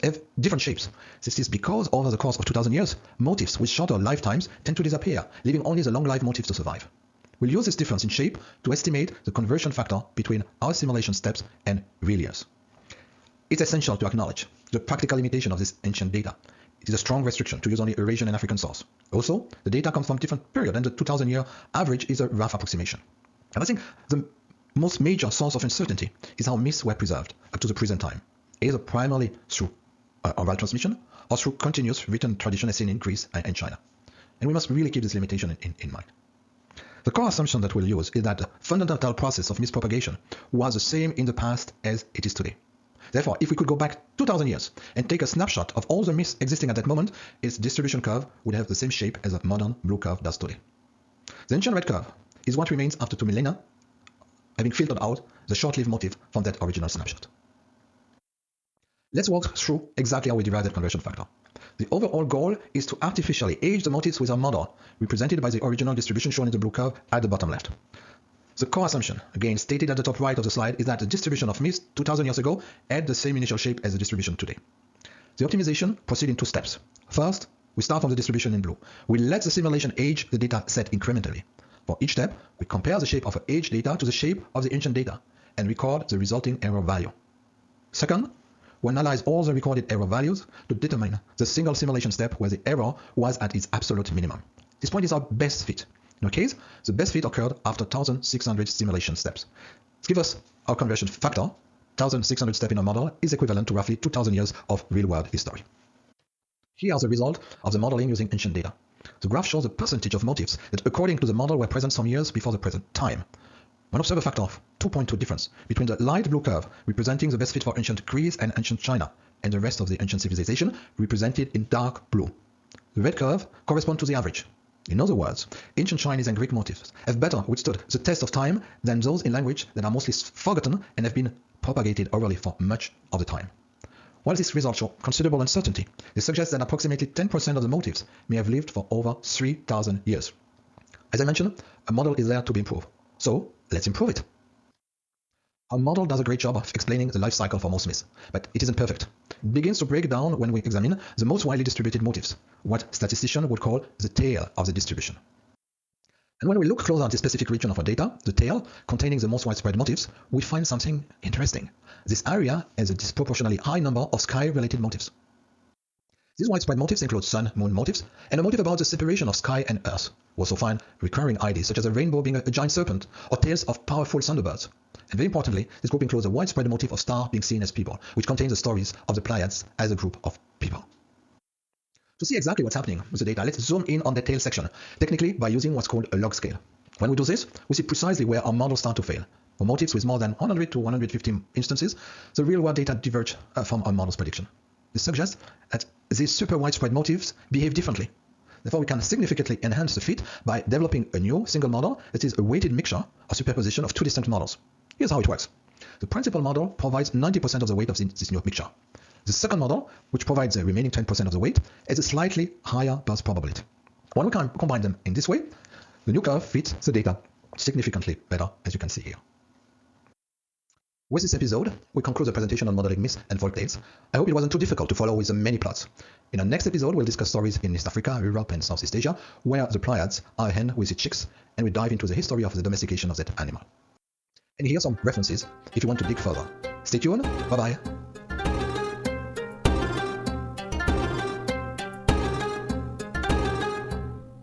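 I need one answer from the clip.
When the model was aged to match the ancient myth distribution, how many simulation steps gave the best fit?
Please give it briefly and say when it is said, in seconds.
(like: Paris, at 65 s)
1600, at 97 s.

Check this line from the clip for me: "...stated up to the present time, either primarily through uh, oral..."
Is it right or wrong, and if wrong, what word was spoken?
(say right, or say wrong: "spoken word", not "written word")
wrong: "preserved", not "stated".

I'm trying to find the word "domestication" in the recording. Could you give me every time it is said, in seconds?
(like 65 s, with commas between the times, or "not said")
232 s.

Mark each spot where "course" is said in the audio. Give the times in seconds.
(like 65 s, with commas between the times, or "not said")
2 s.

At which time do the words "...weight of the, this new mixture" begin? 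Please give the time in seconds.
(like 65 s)
207 s.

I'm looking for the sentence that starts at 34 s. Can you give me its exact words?
And we must really keep this limitation in, in, in mind.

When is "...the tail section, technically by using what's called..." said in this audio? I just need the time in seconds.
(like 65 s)
184 s.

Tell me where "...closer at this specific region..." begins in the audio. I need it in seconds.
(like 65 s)
156 s.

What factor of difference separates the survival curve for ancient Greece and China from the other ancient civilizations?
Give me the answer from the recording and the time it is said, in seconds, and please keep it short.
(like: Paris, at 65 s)
2.2, at 114 s.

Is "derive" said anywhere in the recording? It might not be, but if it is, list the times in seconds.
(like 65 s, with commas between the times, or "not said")
60 s.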